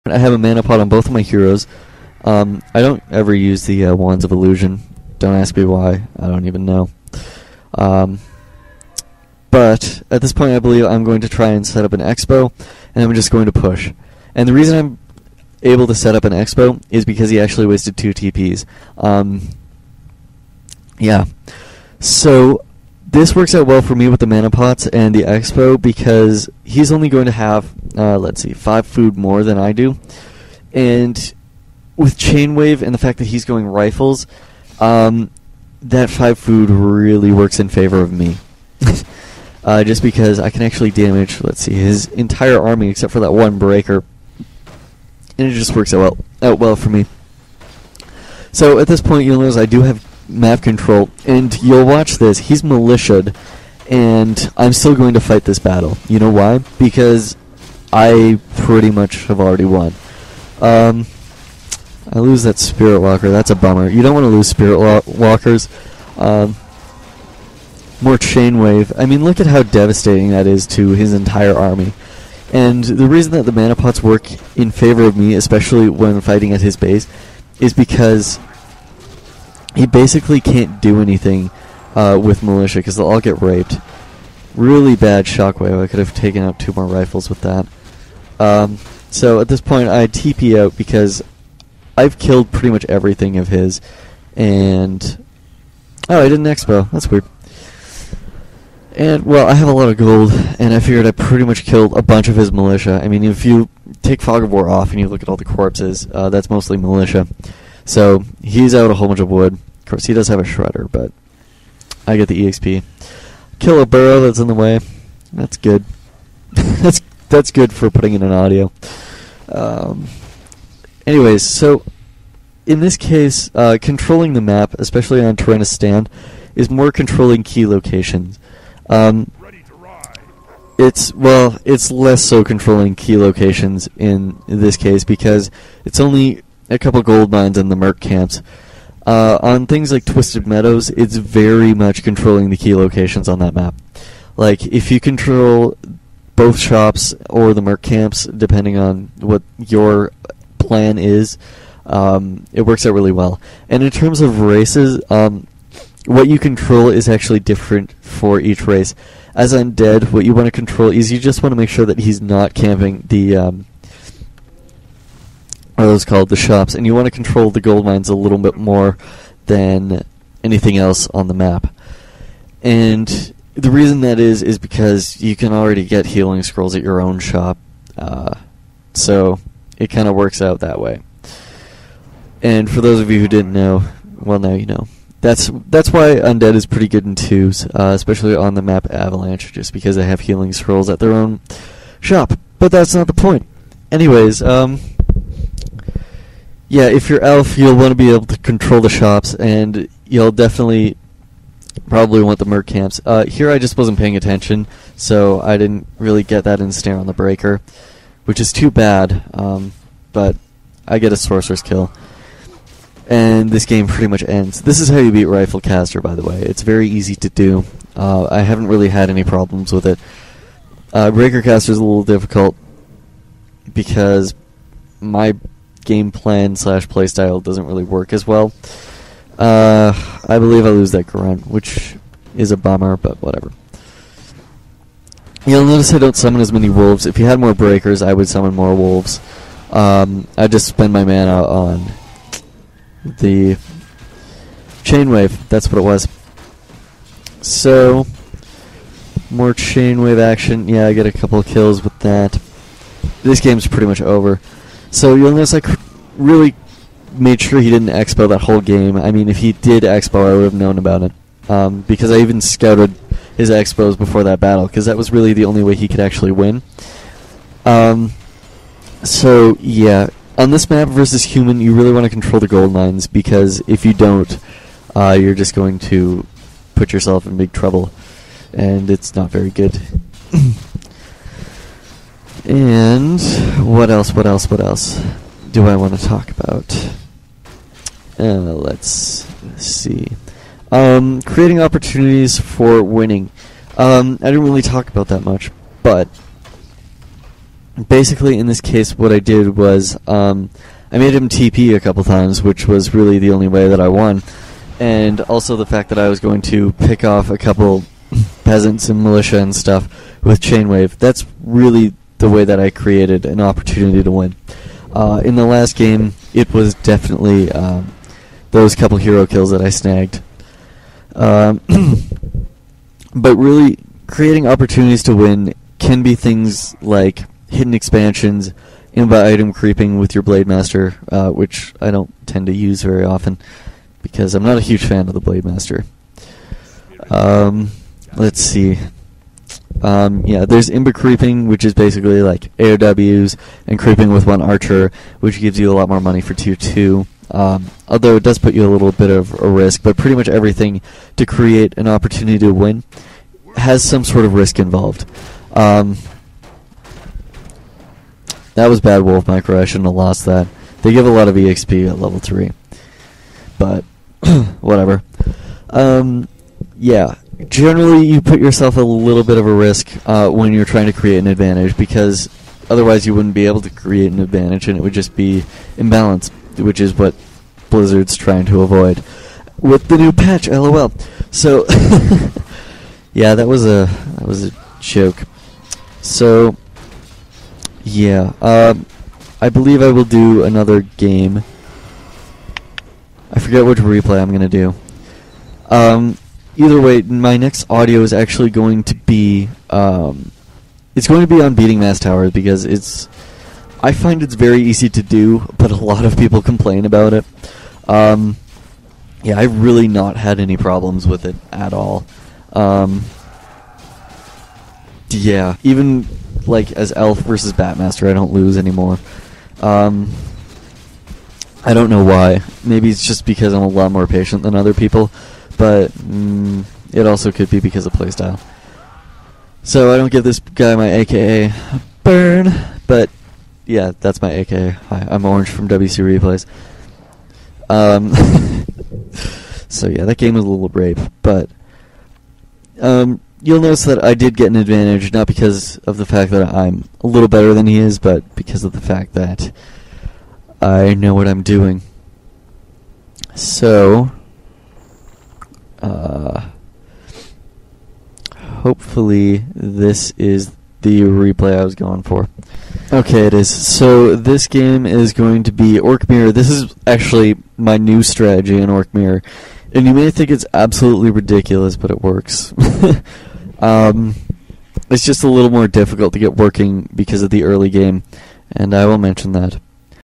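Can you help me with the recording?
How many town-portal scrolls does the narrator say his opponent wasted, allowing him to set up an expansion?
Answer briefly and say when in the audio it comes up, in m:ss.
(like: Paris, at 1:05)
2, at 0:17.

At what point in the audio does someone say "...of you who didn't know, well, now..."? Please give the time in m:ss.
3:02.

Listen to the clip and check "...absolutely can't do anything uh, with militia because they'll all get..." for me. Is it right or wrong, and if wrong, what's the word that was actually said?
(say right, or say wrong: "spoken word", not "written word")
wrong: "basically", not "absolutely".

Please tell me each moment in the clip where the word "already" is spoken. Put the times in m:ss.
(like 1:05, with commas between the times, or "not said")
0:59, 2:55.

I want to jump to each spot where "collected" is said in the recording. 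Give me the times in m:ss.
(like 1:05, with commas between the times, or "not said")
not said.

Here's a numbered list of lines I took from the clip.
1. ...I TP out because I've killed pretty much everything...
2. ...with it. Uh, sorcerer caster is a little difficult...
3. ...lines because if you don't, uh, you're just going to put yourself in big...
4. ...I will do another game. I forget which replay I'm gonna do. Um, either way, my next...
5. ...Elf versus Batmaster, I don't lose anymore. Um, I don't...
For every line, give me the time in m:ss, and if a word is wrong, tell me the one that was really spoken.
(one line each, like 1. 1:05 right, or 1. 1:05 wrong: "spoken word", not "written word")
1. 1:29 right
2. 3:39 wrong: "breaker", not "sorcerer"
3. 4:32 right
4. 6:29 right
5. 6:56 right.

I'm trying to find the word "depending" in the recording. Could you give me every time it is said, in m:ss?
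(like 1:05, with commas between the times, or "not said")
2:28.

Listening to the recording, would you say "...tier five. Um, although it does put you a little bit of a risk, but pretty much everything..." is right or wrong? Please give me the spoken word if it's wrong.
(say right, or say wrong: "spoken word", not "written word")
wrong: "two", not "five".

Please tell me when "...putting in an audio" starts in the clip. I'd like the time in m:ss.
1:57.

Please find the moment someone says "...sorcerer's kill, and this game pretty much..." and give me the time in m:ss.
3:31.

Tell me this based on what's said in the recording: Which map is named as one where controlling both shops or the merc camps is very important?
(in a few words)
Twisted Meadows.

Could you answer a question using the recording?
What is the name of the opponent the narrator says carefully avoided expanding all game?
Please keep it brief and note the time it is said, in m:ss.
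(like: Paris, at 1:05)
Jonas, at 4:15.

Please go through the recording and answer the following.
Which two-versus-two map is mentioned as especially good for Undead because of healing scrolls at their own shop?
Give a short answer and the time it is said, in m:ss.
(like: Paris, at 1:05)
Avalanche, at 3:08.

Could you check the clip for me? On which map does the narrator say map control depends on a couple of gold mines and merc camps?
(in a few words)
Terenas Stand.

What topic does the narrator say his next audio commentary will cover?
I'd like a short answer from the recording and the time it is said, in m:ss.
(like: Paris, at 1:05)
Beating mass towers, at 6:41.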